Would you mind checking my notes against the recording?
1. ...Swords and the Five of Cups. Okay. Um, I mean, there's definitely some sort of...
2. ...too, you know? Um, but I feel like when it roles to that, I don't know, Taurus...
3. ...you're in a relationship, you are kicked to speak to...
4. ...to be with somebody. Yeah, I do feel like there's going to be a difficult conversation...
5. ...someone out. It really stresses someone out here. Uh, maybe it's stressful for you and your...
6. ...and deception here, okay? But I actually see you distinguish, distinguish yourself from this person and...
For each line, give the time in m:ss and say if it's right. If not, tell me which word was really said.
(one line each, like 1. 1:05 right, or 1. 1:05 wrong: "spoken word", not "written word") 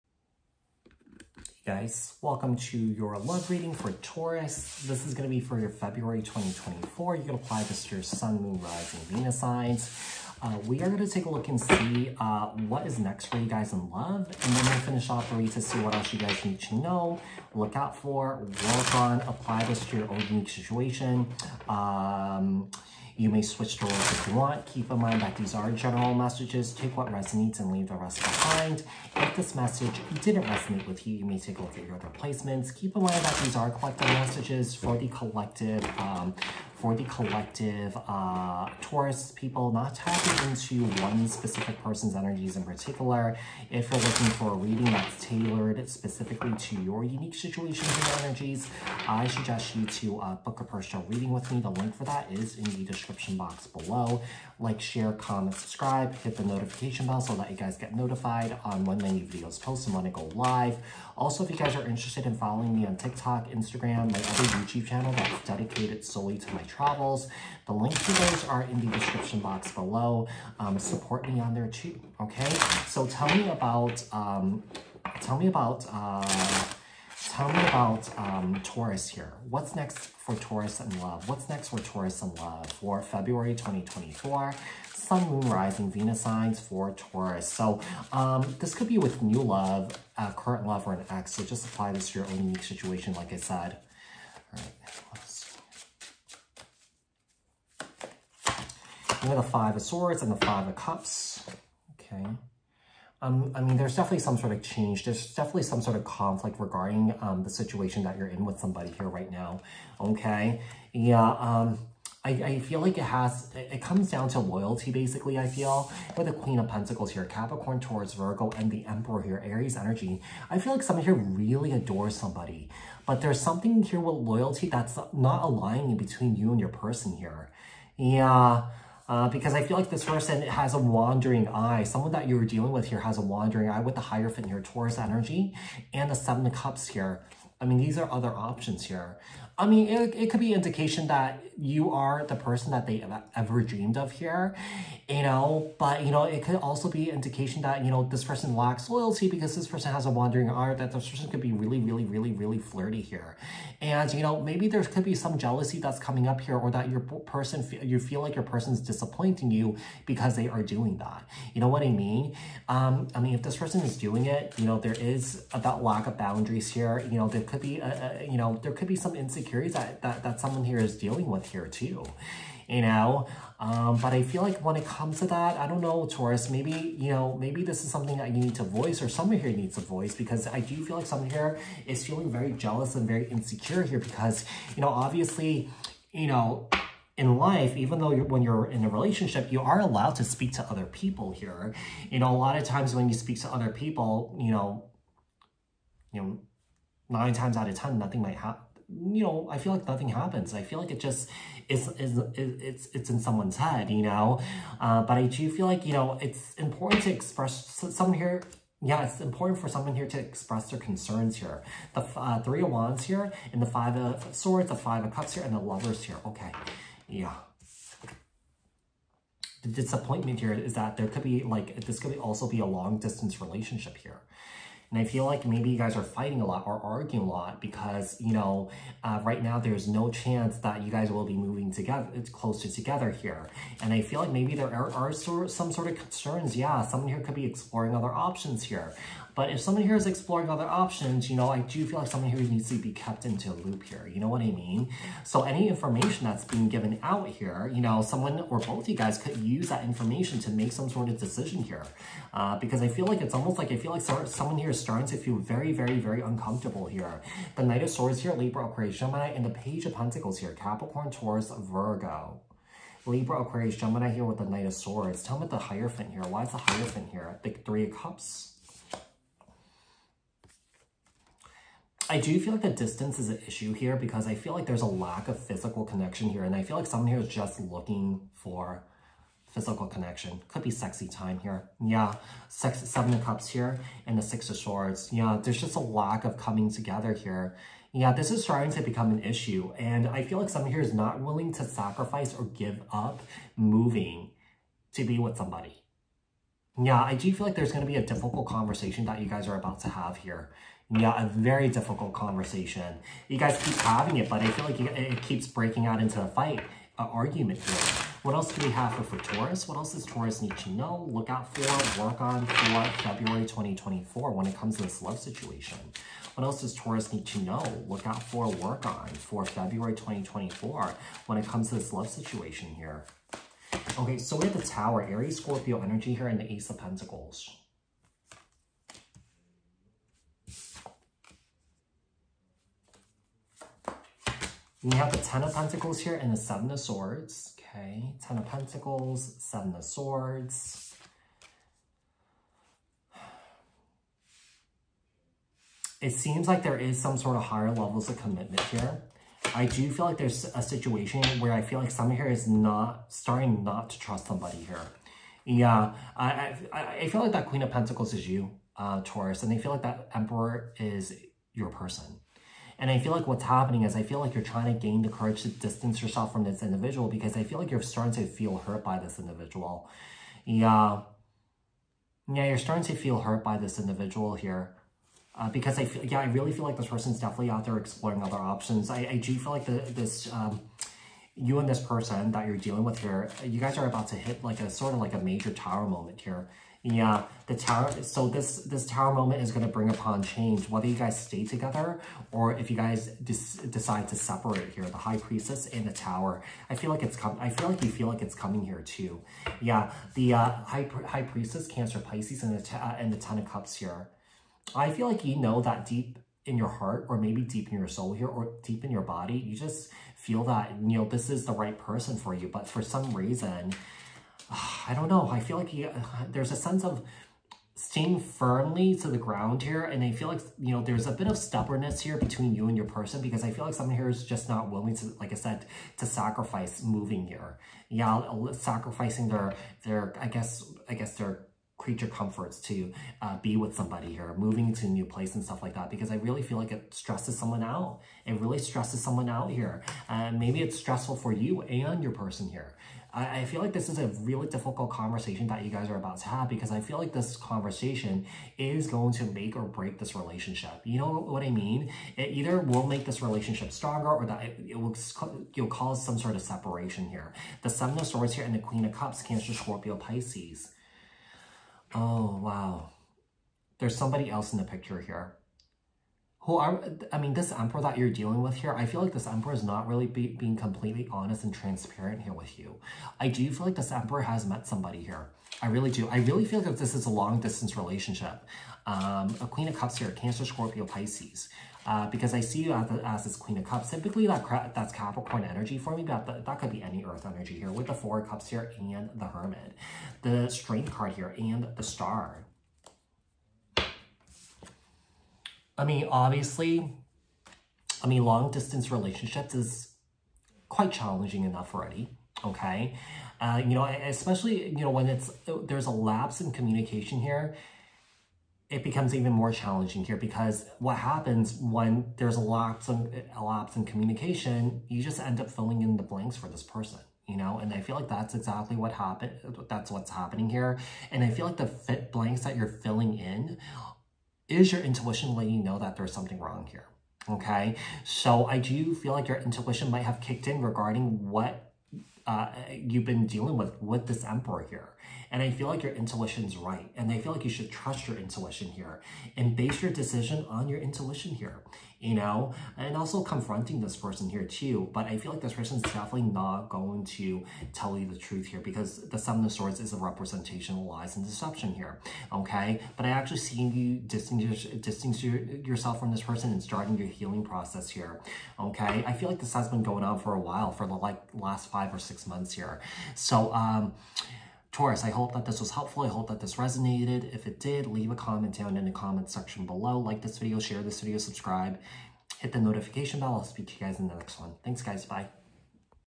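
1. 1:39 right
2. 2:51 wrong: "comes", not "roles"
3. 3:08 wrong: "allowed", not "kicked"
4. 4:54 right
5. 7:17 right
6. 9:11 right.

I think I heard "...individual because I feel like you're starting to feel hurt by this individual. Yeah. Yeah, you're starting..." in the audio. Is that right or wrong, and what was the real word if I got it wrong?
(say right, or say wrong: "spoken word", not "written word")
right.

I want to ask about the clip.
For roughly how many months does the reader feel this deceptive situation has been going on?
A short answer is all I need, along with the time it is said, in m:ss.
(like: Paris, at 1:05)
5 or 6 months, at 9:21.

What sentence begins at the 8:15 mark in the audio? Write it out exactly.
I mean, obviously, I mean, long distance relationships is quite challenging enough already, okay?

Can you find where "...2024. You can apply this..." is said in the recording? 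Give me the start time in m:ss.
0:06.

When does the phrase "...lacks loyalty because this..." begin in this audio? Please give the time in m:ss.
2:28.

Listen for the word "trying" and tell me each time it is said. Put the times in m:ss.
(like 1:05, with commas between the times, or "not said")
6:04.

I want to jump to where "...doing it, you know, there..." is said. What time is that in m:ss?
2:43.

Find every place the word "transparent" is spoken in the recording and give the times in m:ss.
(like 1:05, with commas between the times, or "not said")
7:51.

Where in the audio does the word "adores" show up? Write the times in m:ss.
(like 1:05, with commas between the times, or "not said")
2:01.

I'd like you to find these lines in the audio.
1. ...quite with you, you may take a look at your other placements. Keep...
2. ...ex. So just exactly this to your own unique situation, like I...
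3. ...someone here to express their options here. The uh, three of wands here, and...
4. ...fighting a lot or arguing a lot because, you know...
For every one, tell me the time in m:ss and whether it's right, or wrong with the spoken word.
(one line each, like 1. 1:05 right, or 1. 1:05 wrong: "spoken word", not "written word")
1. 0:30 wrong: "resonate", not "quite"
2. 1:31 wrong: "apply", not "exactly"
3. 3:29 wrong: "concerns", not "options"
4. 3:46 right.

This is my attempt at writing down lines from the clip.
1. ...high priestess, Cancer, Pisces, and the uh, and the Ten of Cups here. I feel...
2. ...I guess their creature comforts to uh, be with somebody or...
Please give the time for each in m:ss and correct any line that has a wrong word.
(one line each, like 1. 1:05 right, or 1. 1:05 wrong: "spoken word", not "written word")
1. 6:41 right
2. 7:10 right.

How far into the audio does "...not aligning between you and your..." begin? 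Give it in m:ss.
2:05.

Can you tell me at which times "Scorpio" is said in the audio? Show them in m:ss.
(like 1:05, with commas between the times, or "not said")
5:25, 7:39, 8:00.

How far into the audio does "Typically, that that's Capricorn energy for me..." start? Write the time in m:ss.
8:03.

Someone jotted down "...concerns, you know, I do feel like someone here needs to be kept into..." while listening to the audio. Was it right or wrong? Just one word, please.
wrong.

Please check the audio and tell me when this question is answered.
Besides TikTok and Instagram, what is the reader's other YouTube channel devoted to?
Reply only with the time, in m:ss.
1:06.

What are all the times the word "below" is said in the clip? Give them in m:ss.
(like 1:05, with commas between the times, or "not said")
0:53, 1:09, 9:29.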